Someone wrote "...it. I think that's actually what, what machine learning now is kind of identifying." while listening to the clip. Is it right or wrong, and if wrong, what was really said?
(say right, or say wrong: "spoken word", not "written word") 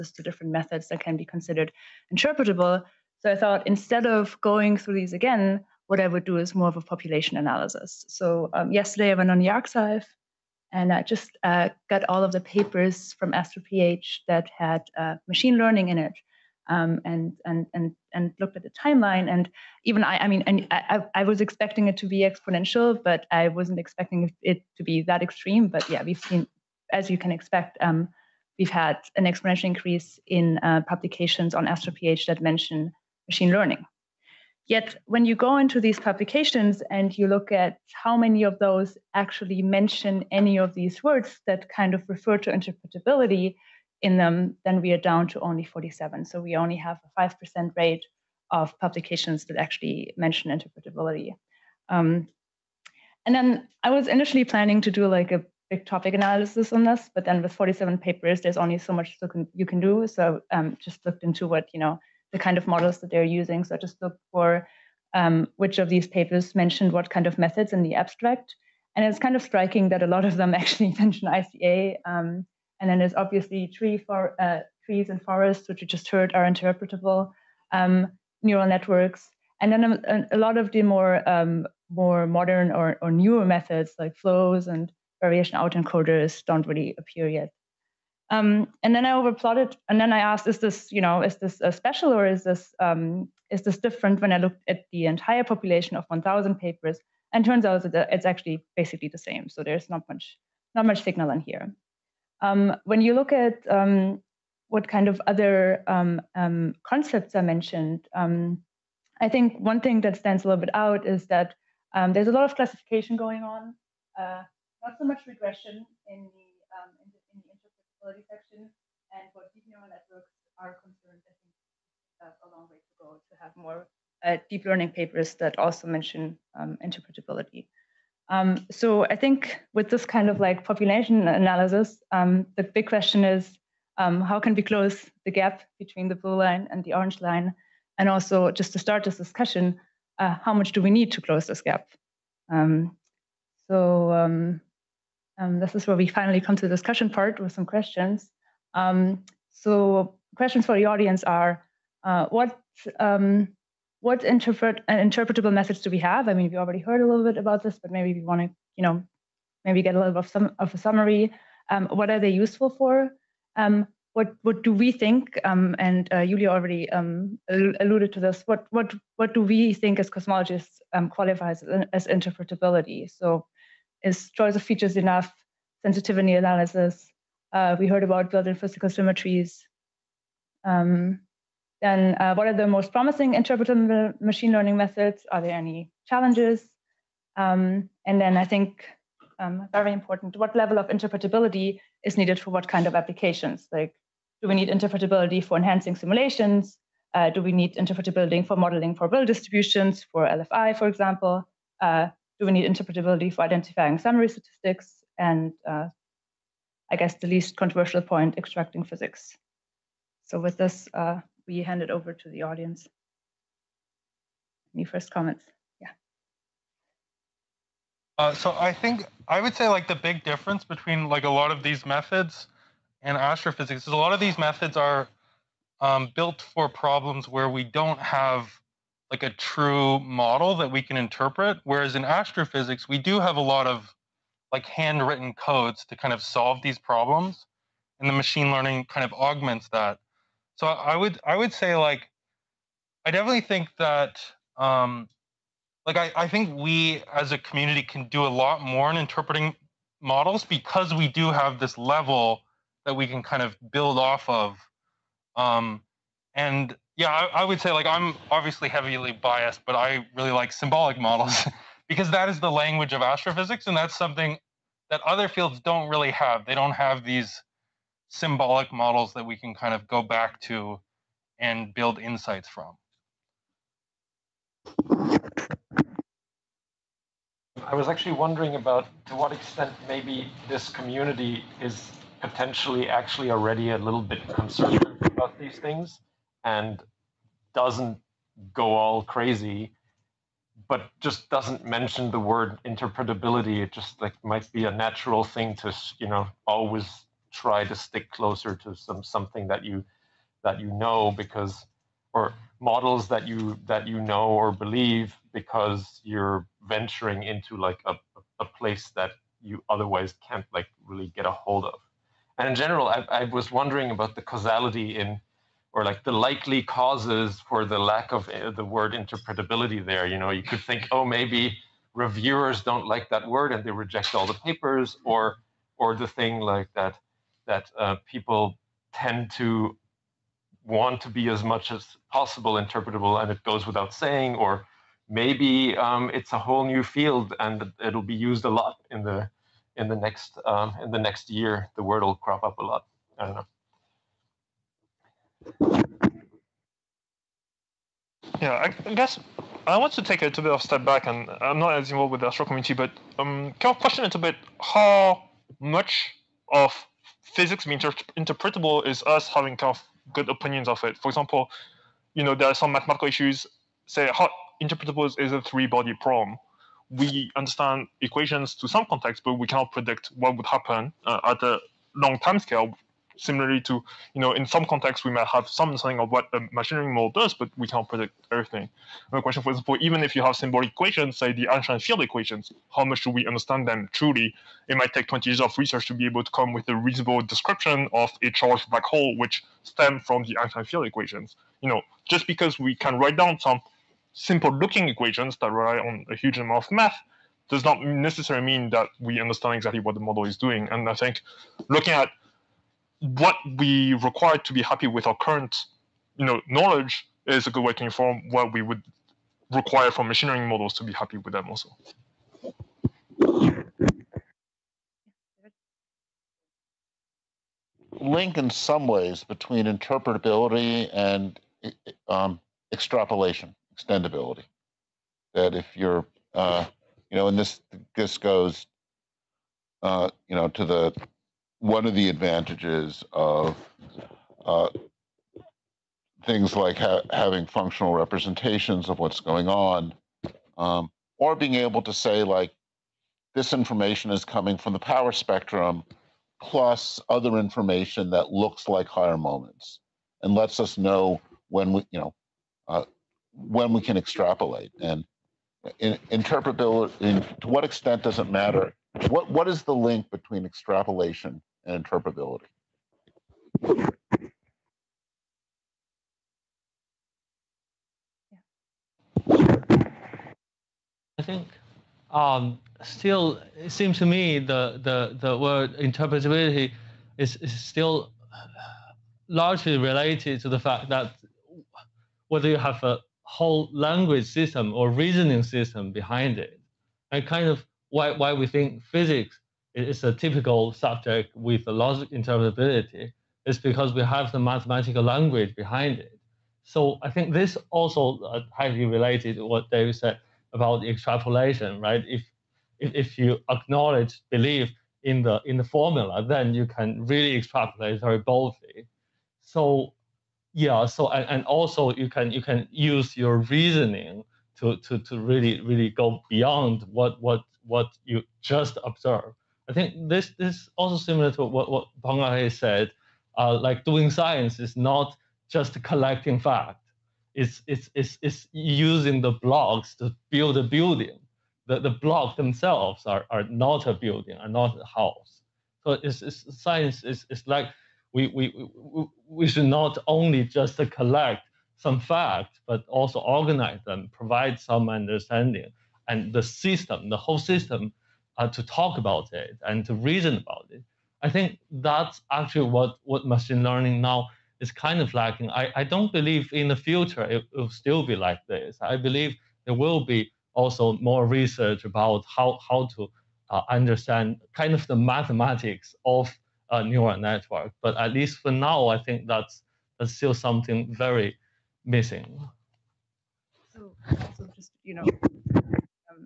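wrong: "lacking", not "identifying".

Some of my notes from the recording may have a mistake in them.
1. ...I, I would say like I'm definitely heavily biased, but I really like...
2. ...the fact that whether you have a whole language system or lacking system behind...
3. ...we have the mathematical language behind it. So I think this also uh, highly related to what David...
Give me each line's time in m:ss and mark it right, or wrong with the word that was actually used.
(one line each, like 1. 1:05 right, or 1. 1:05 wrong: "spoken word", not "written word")
1. 4:17 wrong: "obviously", not "definitely"
2. 8:00 wrong: "reasoning", not "lacking"
3. 8:13 right.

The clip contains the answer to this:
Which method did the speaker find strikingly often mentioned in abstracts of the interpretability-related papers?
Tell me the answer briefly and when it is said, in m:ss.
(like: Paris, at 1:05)
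ICA, at 1:11.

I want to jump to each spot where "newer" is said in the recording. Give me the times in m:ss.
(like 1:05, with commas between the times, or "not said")
1:23.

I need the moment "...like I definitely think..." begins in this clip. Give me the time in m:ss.
4:01.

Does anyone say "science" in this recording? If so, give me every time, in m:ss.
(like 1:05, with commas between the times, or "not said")
8:44, 8:56.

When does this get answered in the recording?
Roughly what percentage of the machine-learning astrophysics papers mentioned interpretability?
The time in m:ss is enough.
0:47.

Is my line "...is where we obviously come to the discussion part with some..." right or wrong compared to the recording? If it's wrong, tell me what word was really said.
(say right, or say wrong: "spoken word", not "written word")
wrong: "finally", not "obviously".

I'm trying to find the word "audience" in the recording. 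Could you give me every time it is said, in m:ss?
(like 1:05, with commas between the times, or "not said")
2:30, 3:32.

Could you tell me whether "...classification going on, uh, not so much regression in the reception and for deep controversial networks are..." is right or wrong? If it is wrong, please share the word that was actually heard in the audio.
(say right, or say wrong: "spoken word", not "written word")
wrong: "neural", not "controversial".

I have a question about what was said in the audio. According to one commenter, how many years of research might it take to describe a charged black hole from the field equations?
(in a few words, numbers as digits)
20.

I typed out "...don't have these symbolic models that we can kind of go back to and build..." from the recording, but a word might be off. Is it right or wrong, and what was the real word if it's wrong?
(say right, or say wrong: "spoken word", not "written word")
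right.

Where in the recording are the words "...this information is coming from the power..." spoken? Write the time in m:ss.
7:23.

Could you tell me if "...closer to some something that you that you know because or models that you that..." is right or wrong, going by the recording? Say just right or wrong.
right.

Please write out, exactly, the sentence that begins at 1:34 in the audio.
When I looked at the entire population of 1,000 papers, and turns out that it's actually basically the same.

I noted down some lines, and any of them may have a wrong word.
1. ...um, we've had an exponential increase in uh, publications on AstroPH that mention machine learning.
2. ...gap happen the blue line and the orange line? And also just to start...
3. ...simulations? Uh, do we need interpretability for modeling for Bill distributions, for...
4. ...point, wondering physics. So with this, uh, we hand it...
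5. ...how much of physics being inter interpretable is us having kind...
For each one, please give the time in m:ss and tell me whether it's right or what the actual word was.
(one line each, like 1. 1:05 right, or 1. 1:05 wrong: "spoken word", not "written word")
1. 0:27 right
2. 2:15 wrong: "between", not "happen"
3. 3:15 right
4. 3:28 wrong: "extracting", not "wondering"
5. 5:54 right.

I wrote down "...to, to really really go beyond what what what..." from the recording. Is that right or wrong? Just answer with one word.
right.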